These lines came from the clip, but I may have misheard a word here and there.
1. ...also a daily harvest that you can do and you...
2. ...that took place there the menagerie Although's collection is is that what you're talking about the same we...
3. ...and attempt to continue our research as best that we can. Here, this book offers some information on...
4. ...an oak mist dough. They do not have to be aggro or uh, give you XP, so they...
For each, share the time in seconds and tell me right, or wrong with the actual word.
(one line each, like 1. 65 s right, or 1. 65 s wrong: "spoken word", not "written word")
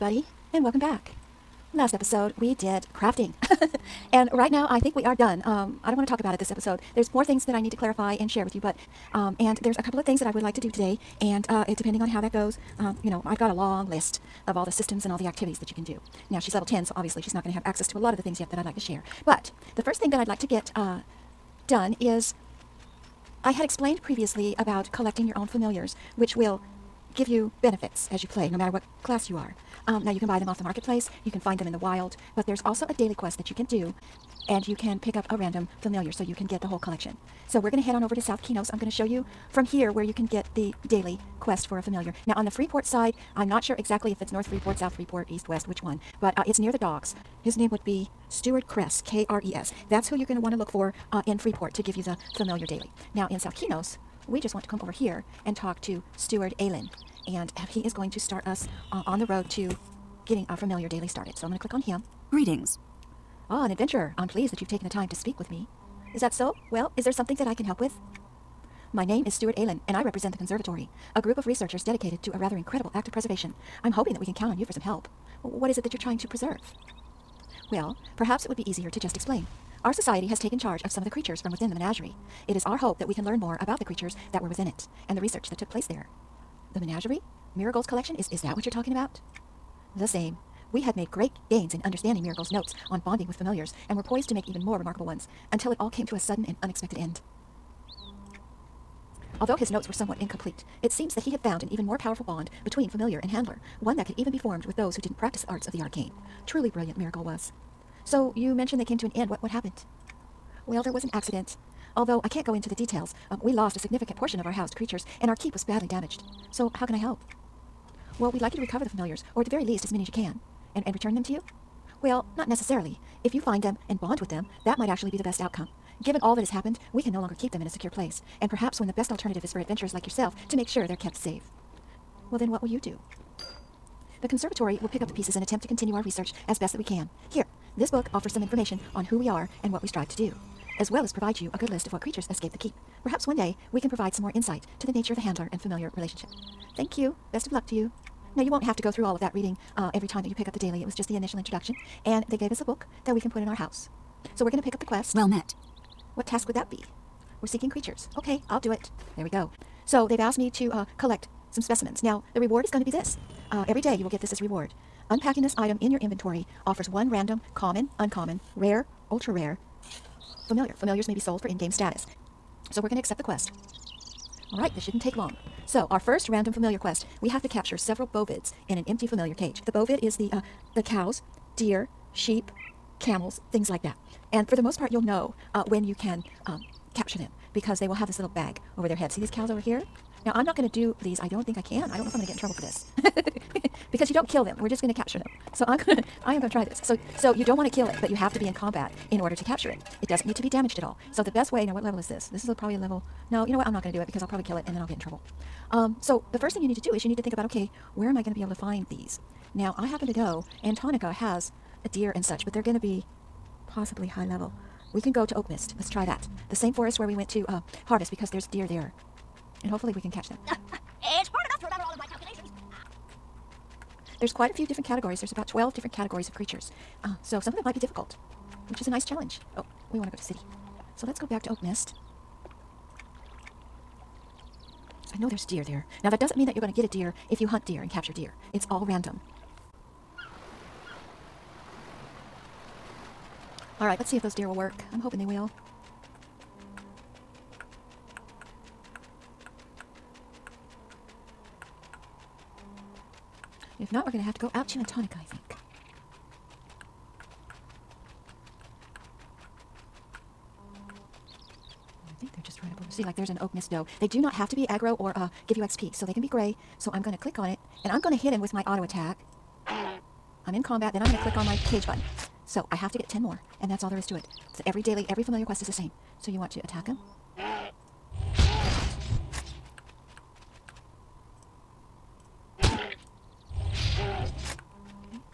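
1. 32 s wrong: "quest", not "harvest"
2. 85 s wrong: "Miragul", not "Although"
3. 135 s right
4. 263 s right.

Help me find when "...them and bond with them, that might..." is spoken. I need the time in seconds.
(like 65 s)
123 s.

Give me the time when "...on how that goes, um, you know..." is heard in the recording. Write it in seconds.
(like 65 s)
12 s.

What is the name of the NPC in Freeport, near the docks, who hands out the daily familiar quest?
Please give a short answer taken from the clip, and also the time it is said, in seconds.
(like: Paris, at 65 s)
Stuart Kress, at 48 s.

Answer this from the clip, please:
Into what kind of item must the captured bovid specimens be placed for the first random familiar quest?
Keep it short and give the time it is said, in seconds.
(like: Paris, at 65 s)
empty familiar cage, at 178 s.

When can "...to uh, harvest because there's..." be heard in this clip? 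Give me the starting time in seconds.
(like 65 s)
217 s.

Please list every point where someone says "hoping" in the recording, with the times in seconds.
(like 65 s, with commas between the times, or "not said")
73 s, 245 s.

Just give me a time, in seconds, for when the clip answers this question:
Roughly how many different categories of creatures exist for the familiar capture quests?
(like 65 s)
225 s.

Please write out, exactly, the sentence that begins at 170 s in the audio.
Familiars may be sold for in game status.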